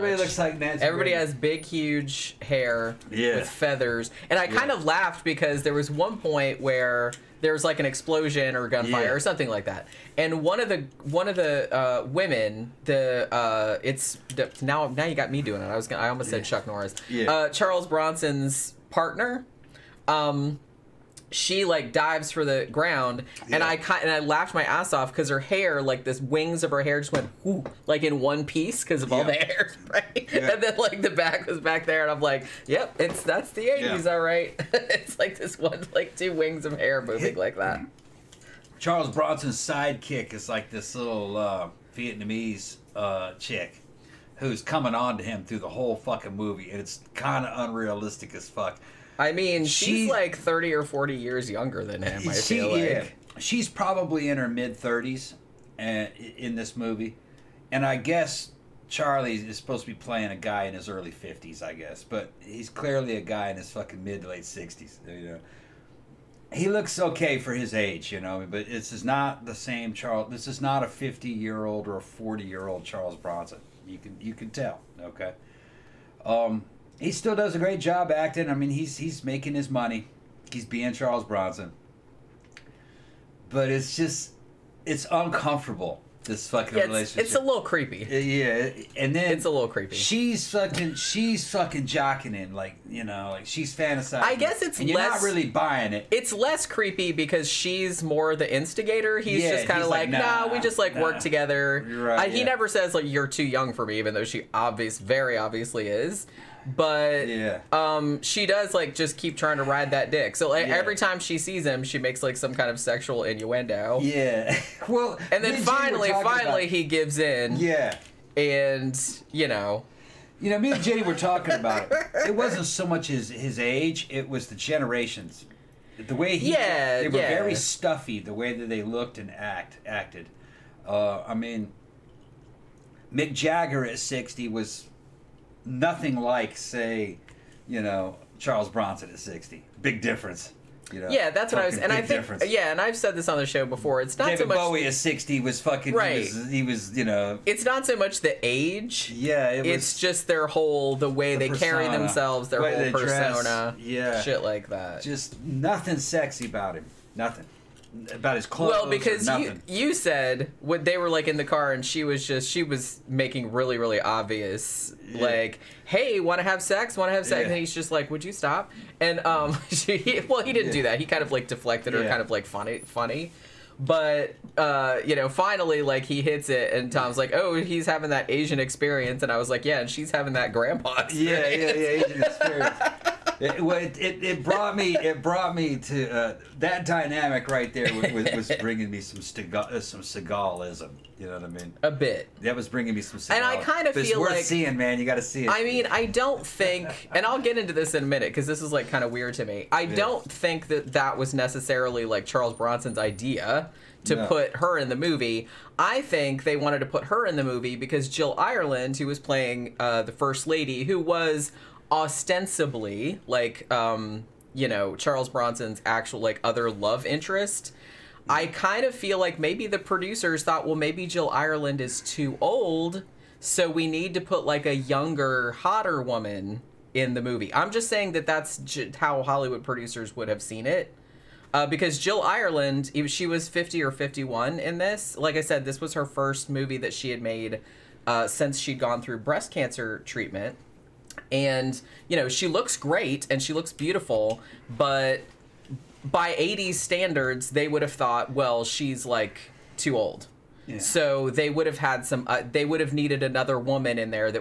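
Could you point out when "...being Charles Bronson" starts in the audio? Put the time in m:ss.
1:20.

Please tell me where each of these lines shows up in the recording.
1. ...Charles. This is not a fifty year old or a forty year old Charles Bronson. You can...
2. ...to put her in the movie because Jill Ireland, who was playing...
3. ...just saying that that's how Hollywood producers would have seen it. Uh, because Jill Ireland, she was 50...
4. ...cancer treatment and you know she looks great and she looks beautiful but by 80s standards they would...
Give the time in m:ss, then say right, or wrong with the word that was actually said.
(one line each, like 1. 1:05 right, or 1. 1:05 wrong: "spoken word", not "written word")
1. 1:09 right
2. 3:26 right
3. 3:47 right
4. 3:59 right.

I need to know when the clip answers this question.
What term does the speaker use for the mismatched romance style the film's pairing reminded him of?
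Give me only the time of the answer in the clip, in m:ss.
3:10.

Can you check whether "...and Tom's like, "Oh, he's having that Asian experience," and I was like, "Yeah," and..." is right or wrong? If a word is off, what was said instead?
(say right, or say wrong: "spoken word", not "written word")
right.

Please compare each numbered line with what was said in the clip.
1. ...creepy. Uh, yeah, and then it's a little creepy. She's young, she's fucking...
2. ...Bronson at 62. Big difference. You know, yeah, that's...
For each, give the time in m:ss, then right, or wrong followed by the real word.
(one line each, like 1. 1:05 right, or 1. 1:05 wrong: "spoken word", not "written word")
1. 1:27 wrong: "fucking", not "young"
2. 2:18 wrong: "60", not "62".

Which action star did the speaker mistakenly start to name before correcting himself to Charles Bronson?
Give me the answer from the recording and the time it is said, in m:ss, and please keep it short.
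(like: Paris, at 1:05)
Chuck Norris, at 0:16.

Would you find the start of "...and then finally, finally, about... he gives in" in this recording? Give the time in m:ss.
1:55.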